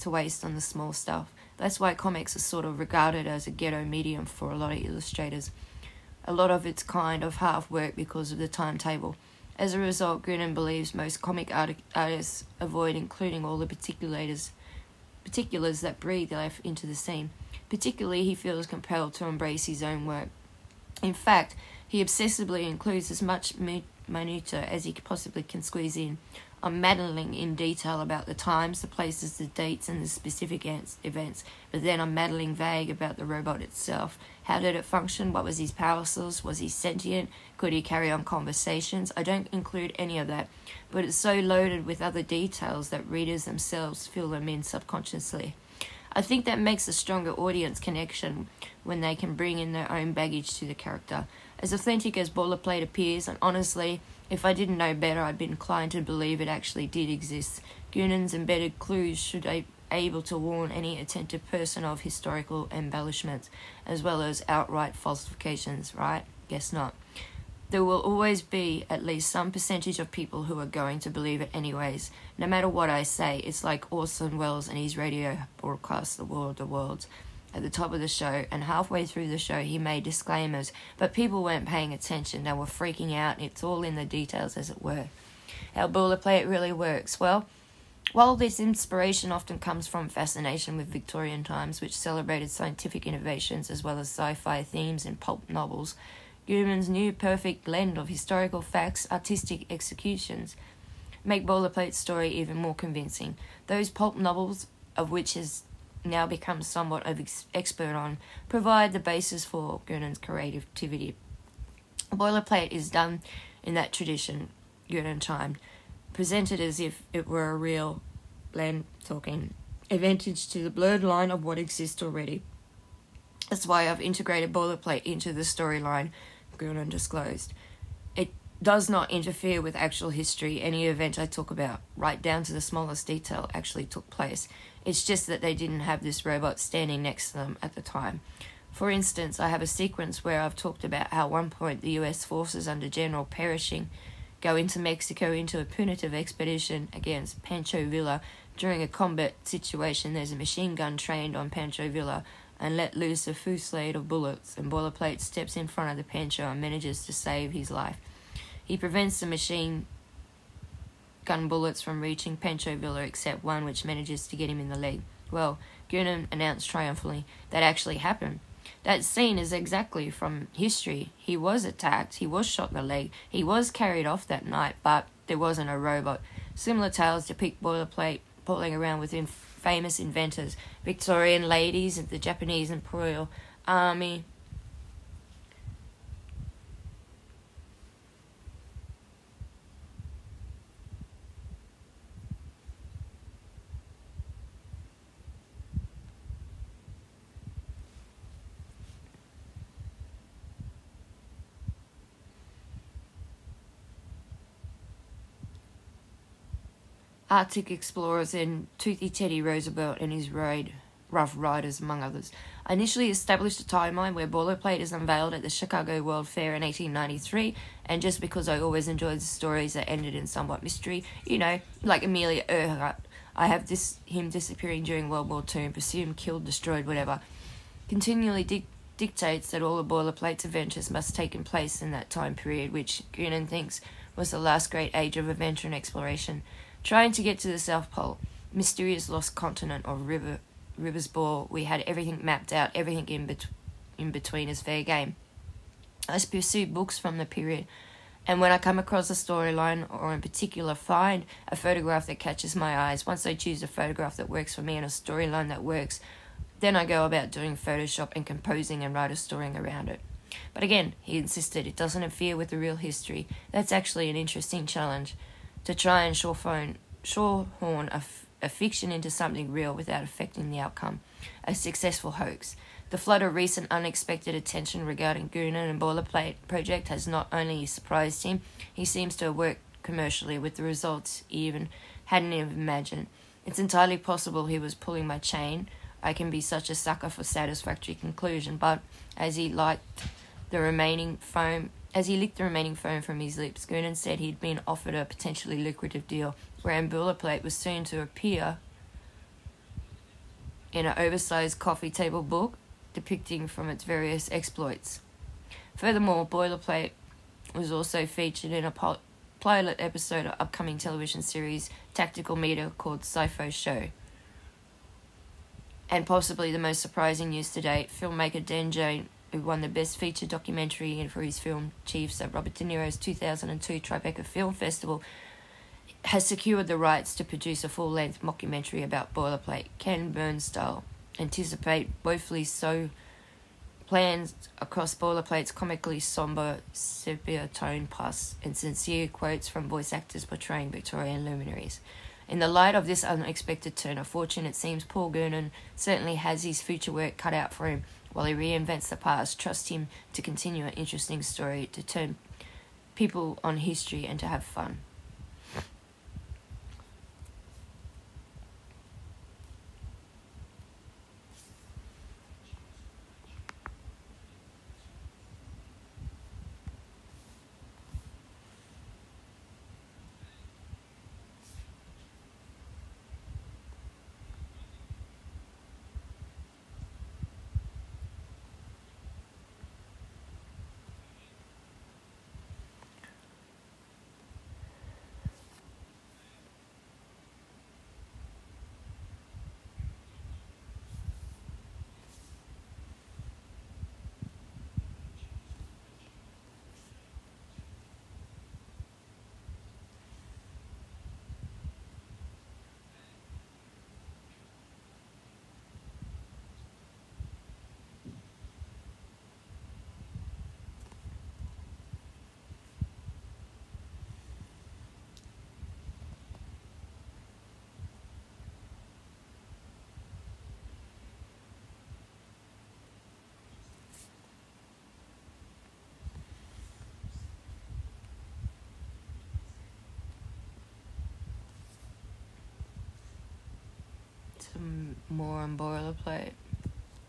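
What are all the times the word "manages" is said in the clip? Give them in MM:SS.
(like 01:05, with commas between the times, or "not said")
02:36, 02:43.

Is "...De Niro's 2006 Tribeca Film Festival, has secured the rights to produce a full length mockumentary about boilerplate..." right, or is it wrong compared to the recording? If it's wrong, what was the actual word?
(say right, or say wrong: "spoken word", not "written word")
wrong: "2002", not "2006".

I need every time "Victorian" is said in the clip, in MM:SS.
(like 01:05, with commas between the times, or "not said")
01:30, 03:00, 05:40.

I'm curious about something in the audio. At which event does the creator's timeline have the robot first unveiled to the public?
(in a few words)
Chicago World Fair.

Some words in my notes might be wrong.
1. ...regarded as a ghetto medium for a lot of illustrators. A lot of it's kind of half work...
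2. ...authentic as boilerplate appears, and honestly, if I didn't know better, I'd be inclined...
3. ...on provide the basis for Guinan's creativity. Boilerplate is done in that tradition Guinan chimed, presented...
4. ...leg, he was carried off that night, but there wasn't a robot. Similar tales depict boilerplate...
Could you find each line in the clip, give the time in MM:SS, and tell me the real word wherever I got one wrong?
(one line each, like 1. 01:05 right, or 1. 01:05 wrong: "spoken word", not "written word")
1. 00:02 right
2. 00:51 right
3. 01:47 right
4. 02:52 right.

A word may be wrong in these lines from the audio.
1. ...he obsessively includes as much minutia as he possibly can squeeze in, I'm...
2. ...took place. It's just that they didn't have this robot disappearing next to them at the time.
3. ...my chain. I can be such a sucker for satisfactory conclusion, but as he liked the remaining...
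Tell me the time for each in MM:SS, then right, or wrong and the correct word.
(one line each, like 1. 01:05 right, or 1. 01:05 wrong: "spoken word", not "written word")
1. 00:21 right
2. 02:13 wrong: "standing", not "disappearing"
3. 04:45 right.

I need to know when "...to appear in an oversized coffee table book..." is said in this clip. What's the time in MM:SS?
04:57.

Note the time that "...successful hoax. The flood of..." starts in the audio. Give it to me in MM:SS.
04:31.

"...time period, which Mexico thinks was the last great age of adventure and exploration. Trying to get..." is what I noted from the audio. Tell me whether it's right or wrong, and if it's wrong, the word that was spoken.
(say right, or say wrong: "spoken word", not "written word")
wrong: "Guinan", not "Mexico".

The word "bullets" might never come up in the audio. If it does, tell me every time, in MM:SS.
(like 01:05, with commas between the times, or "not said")
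02:34, 02:41.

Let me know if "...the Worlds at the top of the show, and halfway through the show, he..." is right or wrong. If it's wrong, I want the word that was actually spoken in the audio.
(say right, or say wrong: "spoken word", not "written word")
right.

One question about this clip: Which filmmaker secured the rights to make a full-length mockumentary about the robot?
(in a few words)
Dan Junge.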